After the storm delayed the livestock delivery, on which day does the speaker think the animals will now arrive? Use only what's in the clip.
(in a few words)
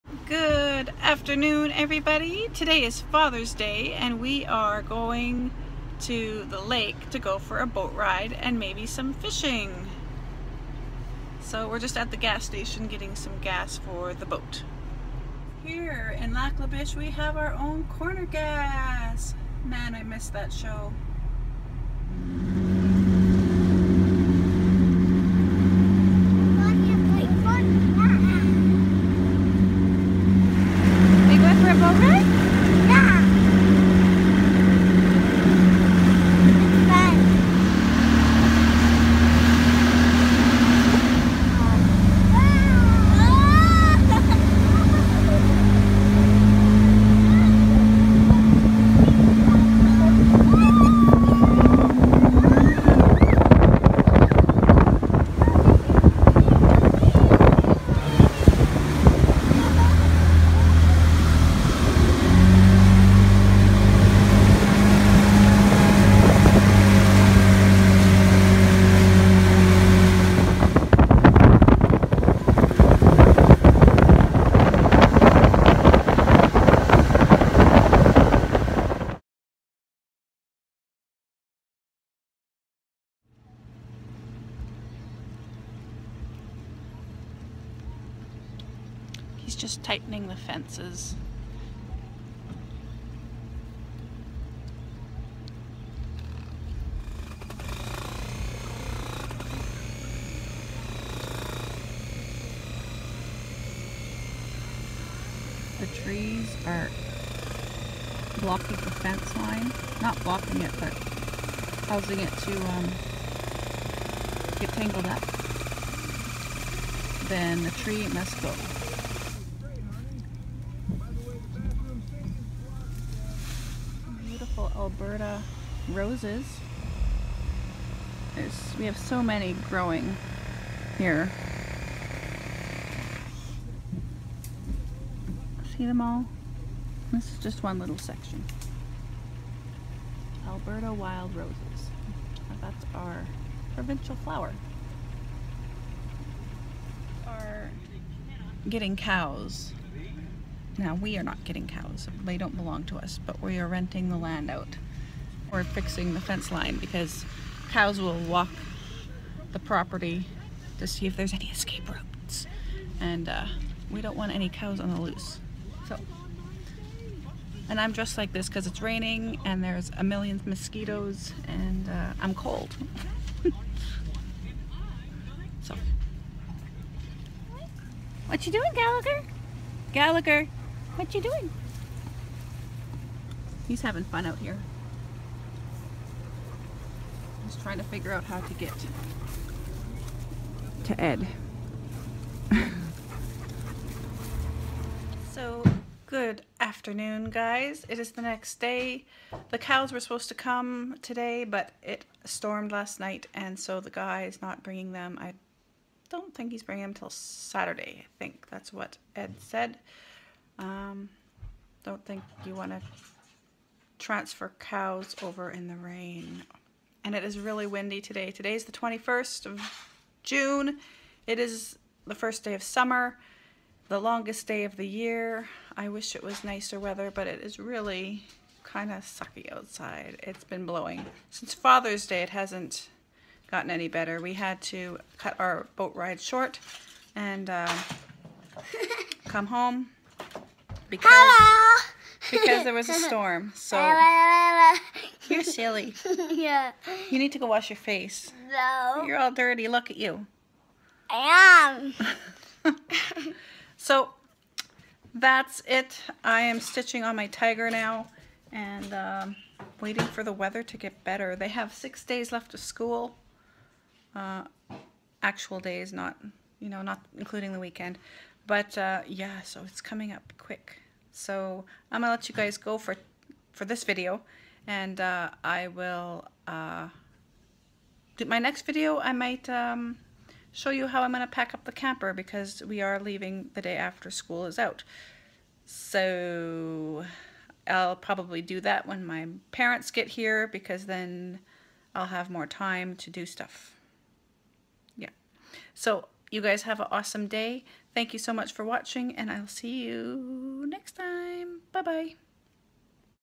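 Saturday.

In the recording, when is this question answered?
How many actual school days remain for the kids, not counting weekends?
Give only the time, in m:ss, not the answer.
4:21.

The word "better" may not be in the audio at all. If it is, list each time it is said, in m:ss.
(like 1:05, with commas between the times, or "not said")
3:53, 4:21.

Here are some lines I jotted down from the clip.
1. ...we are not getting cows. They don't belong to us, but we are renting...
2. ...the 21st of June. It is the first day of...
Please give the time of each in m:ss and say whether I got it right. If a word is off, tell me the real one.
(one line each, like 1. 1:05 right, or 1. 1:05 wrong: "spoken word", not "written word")
1. 2:30 right
2. 3:38 right.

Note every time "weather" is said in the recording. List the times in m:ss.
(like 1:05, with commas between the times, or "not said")
3:46, 4:20.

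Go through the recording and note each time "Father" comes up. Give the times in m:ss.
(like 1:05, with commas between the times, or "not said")
0:03, 3:51.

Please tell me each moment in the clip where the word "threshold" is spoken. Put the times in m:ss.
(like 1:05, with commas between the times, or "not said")
not said.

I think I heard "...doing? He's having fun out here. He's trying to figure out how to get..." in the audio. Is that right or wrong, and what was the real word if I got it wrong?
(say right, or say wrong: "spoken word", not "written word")
right.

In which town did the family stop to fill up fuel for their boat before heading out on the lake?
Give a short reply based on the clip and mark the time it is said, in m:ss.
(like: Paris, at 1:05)
Lac La Biche, at 0:16.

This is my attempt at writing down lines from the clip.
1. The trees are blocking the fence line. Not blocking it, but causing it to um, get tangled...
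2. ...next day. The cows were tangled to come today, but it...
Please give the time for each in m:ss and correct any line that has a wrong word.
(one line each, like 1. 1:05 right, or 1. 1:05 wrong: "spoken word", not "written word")
1. 1:45 right
2. 3:18 wrong: "supposed", not "tangled".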